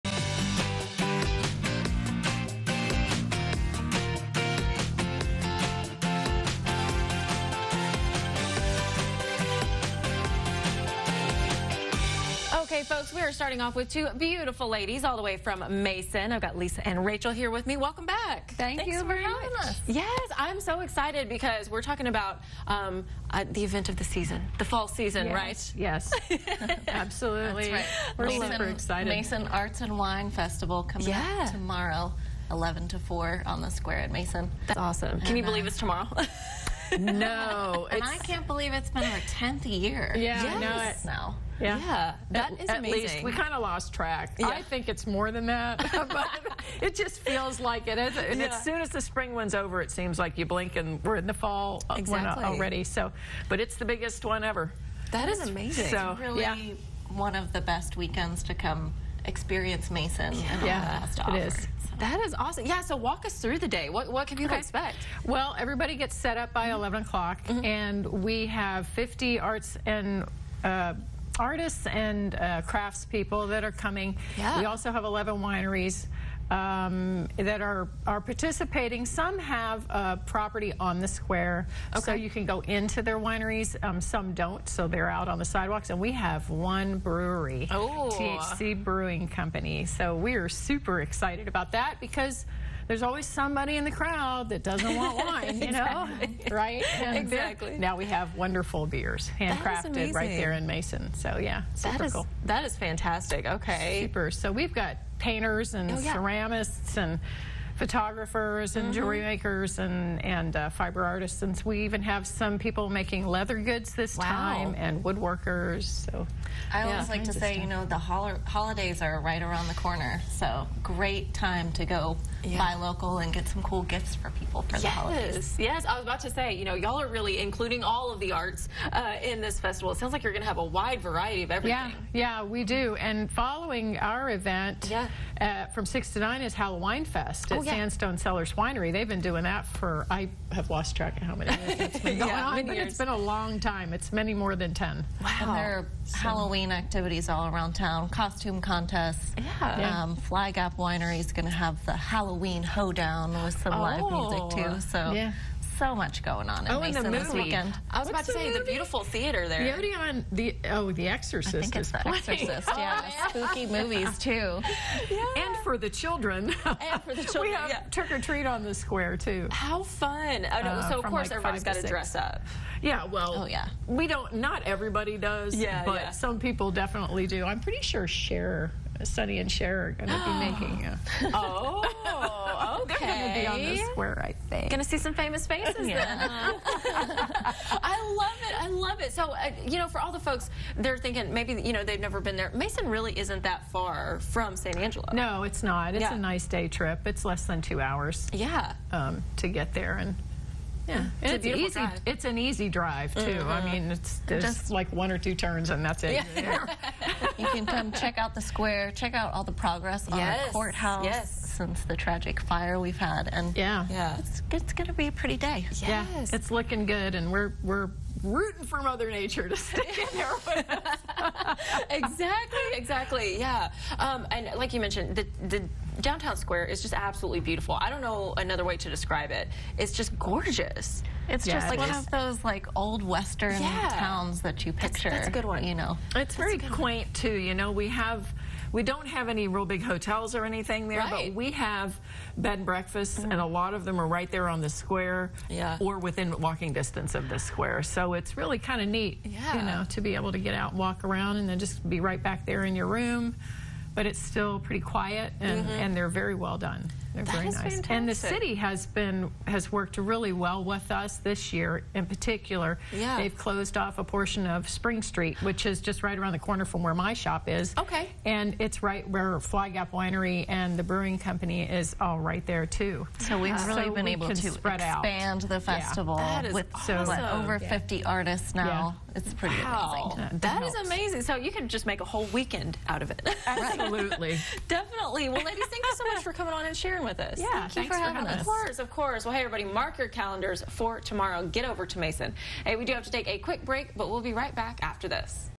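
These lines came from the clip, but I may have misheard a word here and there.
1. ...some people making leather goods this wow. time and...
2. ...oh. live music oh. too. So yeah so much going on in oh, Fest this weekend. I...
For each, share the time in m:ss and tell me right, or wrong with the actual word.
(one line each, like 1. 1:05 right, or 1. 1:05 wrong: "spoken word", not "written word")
1. 1:52 right
2. 2:33 wrong: "Mason", not "Fest".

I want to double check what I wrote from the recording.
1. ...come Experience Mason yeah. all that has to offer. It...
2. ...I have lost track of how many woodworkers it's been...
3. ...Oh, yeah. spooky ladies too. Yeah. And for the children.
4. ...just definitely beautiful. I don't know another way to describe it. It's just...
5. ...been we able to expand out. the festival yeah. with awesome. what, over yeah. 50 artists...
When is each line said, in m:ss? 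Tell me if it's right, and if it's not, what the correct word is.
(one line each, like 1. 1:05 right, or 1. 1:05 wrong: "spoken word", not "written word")
1. 0:58 right
2. 2:20 wrong: "years", not "woodworkers"
3. 2:42 wrong: "movies", not "ladies"
4. 3:46 wrong: "absolutely", not "definitely"
5. 4:33 right.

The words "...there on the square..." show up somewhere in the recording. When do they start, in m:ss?
4:04.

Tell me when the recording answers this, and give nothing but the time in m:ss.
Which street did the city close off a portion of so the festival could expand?
4:24.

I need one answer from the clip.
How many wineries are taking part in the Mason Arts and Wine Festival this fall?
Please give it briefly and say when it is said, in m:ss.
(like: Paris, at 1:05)
11, at 1:15.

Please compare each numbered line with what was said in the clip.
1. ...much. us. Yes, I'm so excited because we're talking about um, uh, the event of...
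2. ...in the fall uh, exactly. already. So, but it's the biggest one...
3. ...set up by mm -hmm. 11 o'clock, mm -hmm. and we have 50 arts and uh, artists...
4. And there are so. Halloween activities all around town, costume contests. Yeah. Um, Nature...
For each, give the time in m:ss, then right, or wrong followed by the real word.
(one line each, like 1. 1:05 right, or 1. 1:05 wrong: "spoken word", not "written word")
1. 0:19 right
2. 0:51 right
3. 1:06 right
4. 2:25 wrong: "Fly", not "Nature".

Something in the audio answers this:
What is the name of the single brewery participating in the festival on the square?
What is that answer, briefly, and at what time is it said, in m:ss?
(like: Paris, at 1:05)
THC Brewing Company, at 1:28.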